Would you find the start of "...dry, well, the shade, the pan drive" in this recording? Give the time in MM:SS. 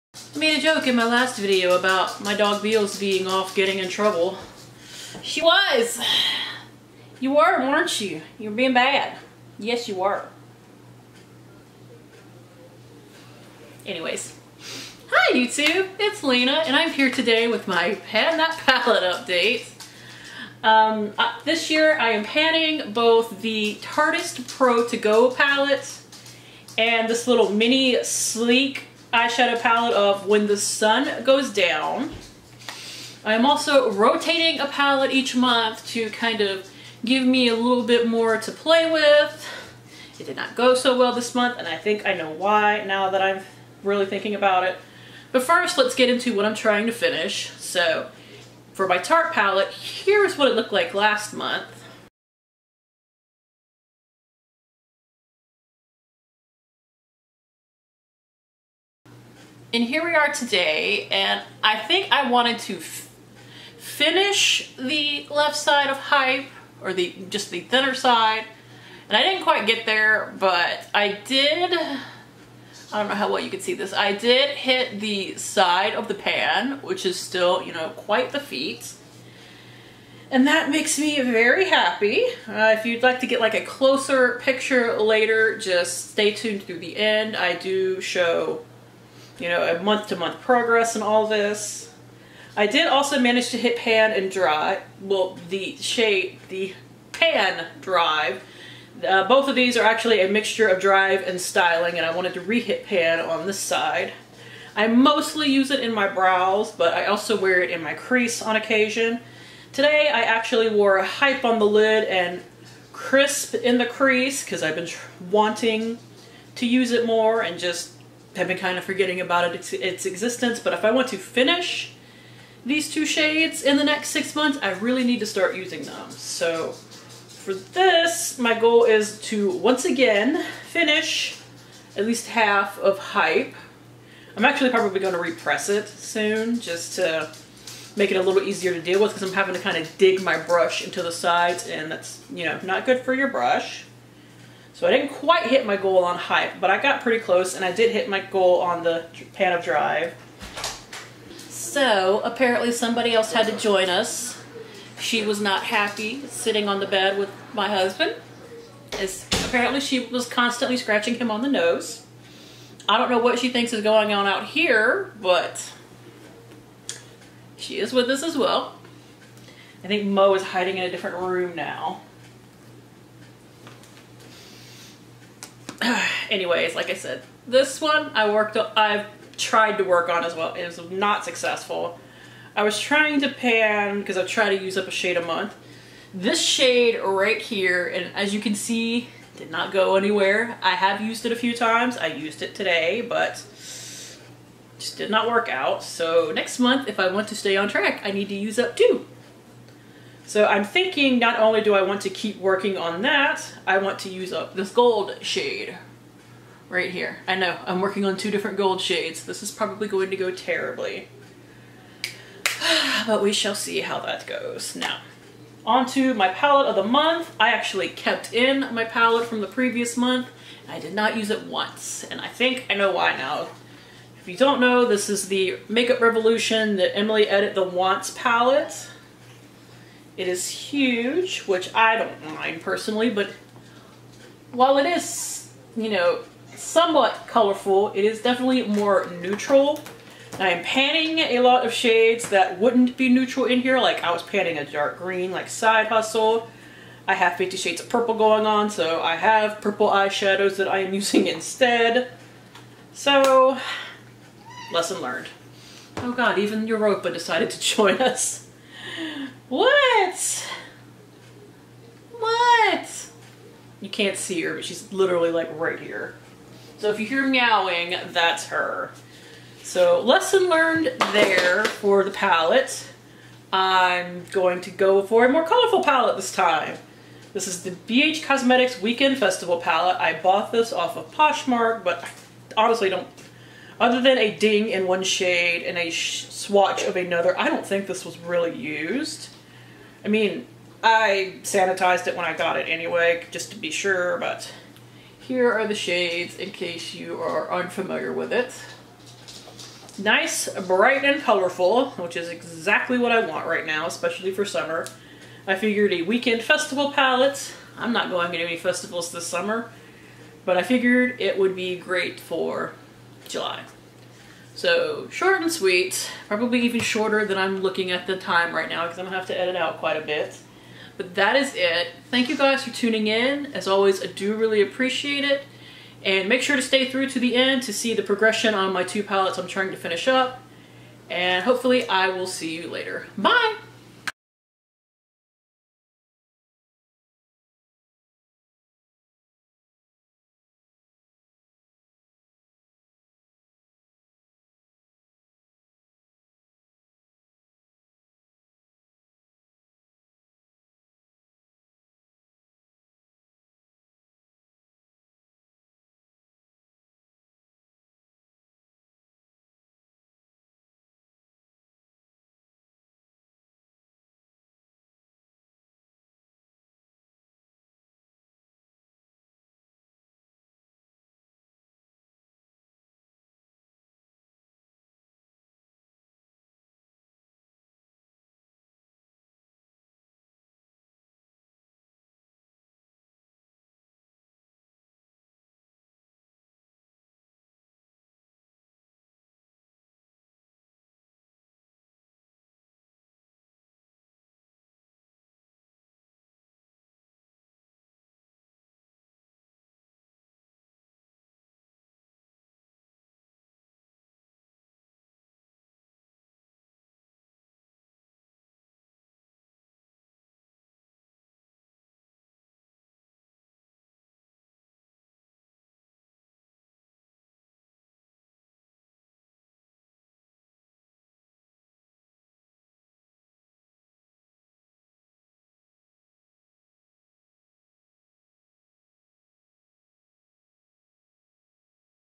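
01:34.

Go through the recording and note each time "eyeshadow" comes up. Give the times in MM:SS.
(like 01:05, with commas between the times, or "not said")
00:29, 04:09.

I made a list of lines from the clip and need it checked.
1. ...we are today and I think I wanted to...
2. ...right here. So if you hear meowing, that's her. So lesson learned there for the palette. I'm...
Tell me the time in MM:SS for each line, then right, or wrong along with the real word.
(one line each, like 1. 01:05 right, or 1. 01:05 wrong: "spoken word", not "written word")
1. 01:00 right
2. 04:25 right.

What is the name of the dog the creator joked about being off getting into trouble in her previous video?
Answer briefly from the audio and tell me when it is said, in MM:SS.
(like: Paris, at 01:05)
Beals, at 00:02.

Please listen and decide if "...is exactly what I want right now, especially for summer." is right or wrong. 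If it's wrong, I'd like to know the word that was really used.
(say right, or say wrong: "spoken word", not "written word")
right.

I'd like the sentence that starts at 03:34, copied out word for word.
Now, onto my palette of the month.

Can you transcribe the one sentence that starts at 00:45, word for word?
But first, let's get into what I'm trying to finish.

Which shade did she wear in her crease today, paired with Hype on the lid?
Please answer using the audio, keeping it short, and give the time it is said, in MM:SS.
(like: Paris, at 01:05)
Crisp, at 01:52.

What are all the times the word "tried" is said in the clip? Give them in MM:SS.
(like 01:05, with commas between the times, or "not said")
02:59, 03:04.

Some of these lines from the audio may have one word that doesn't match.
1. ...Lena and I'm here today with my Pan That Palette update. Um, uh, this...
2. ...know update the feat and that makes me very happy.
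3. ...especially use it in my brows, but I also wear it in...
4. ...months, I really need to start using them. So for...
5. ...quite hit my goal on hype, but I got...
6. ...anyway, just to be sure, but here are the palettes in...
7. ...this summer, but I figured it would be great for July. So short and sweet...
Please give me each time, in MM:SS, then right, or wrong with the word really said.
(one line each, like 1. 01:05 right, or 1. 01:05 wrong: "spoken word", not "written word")
1. 00:16 right
2. 01:17 wrong: "quite", not "update"
3. 01:44 wrong: "mostly", not "especially"
4. 02:04 right
5. 02:25 right
6. 04:52 wrong: "shades", not "palettes"
7. 05:09 right.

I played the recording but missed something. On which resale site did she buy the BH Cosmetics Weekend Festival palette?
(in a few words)
Poshmark.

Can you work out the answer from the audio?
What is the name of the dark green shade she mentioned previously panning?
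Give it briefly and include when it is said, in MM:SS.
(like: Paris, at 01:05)
Side Hustle, at 04:05.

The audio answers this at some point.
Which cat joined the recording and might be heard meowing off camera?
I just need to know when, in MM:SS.
04:16.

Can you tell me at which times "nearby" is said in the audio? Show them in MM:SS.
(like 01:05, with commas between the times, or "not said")
not said.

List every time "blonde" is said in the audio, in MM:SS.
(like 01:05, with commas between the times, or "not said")
not said.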